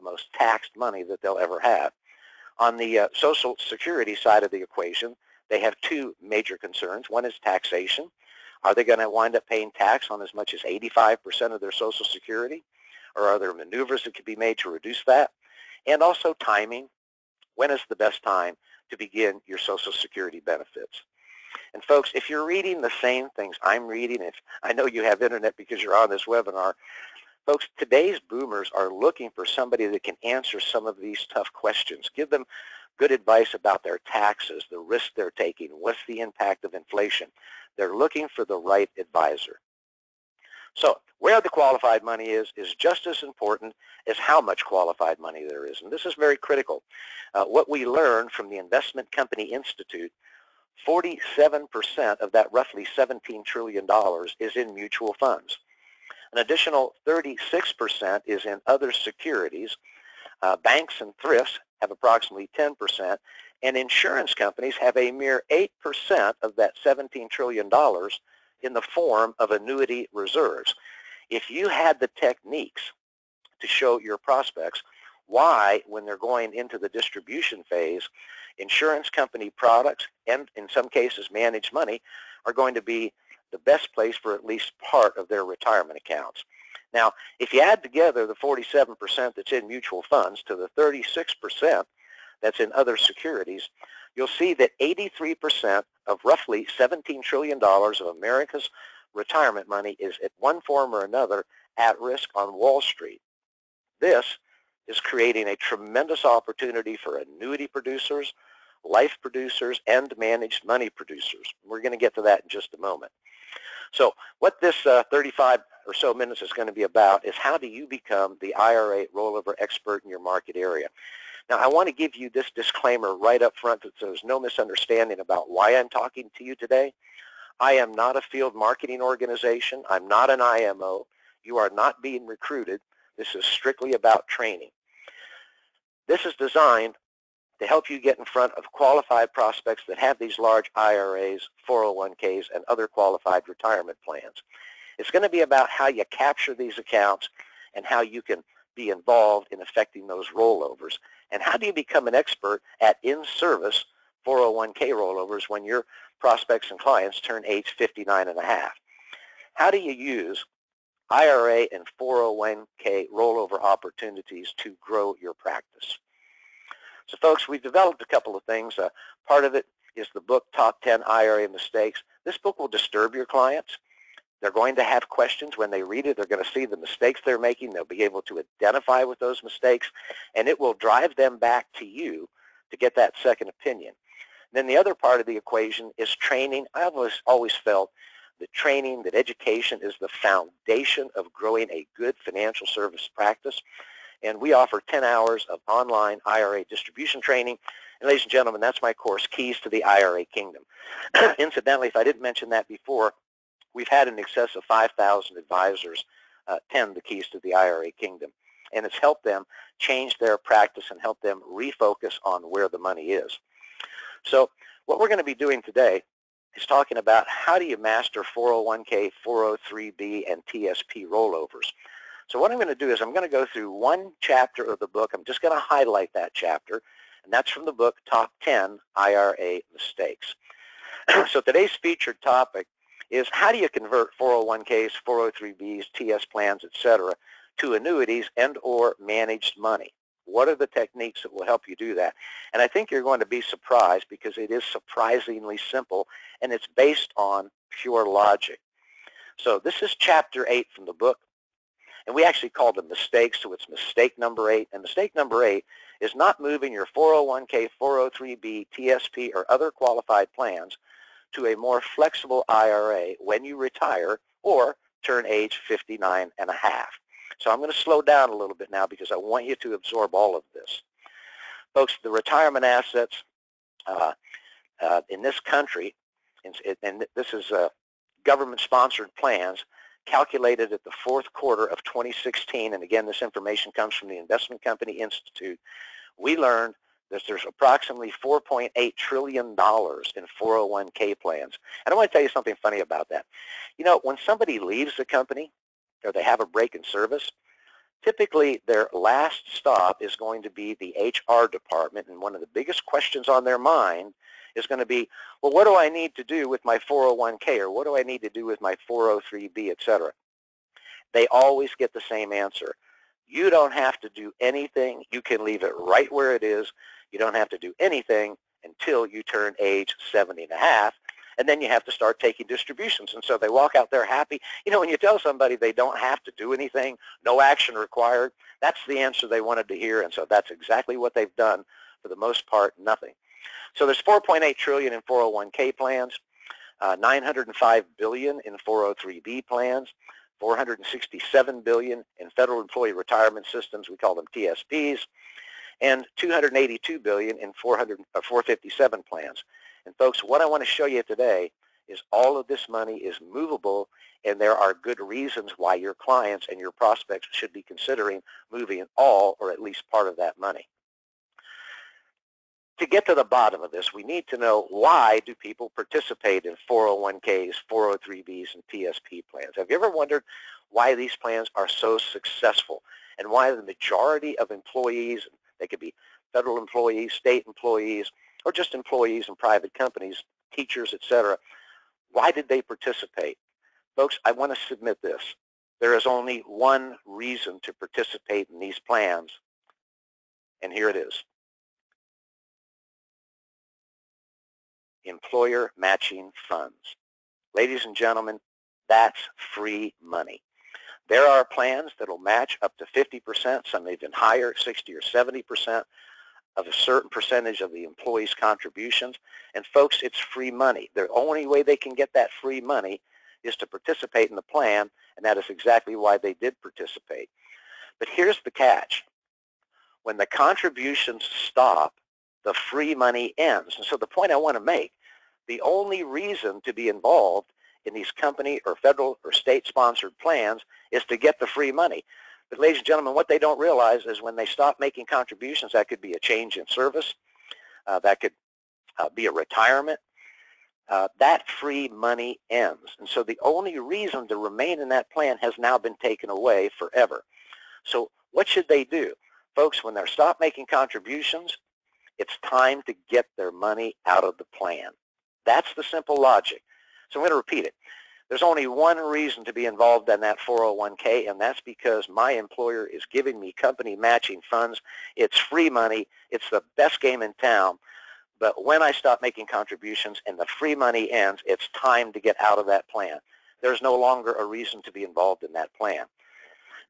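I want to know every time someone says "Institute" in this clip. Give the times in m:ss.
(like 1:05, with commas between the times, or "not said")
0:49, 4:44.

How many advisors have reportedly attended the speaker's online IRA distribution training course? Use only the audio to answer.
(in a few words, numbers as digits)
5,000.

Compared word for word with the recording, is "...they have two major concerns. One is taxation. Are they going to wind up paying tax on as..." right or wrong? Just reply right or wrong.
right.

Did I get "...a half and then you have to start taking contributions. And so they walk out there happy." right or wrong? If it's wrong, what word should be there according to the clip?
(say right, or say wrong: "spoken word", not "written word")
wrong: "distributions", not "contributions".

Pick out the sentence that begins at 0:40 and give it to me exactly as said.
So where the qualified money is is just as important as how much qualified money there is.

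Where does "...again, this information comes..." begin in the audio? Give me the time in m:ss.
4:42.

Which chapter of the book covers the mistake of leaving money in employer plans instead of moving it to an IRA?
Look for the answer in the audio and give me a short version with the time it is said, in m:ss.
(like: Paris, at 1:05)
Chapter 8, at 4:09.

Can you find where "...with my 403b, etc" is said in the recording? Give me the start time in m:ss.
5:08.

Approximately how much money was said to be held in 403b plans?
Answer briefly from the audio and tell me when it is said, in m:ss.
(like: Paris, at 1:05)
$905 billion, at 5:36.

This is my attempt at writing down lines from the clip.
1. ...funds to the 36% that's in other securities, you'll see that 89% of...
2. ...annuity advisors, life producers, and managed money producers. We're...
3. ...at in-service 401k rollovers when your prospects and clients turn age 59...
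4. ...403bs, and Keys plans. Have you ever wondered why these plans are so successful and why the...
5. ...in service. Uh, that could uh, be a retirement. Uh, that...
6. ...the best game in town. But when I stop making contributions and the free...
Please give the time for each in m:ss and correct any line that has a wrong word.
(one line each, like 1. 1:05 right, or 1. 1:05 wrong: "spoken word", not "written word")
1. 1:30 wrong: "83", not "89"
2. 1:47 wrong: "producers", not "advisors"
3. 2:32 right
4. 6:07 wrong: "TSP", not "Keys"
5. 7:16 right
6. 7:46 right.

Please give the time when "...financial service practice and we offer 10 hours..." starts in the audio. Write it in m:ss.
3:12.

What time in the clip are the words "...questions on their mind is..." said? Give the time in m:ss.
5:02.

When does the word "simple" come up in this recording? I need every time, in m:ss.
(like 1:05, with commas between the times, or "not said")
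4:05, 7:35.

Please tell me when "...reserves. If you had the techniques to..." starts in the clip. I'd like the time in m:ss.
1:10.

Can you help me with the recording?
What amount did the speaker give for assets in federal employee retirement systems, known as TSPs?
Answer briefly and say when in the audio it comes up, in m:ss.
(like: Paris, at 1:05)
$467 billion, at 5:40.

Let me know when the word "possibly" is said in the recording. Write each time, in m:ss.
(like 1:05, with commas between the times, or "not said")
not said.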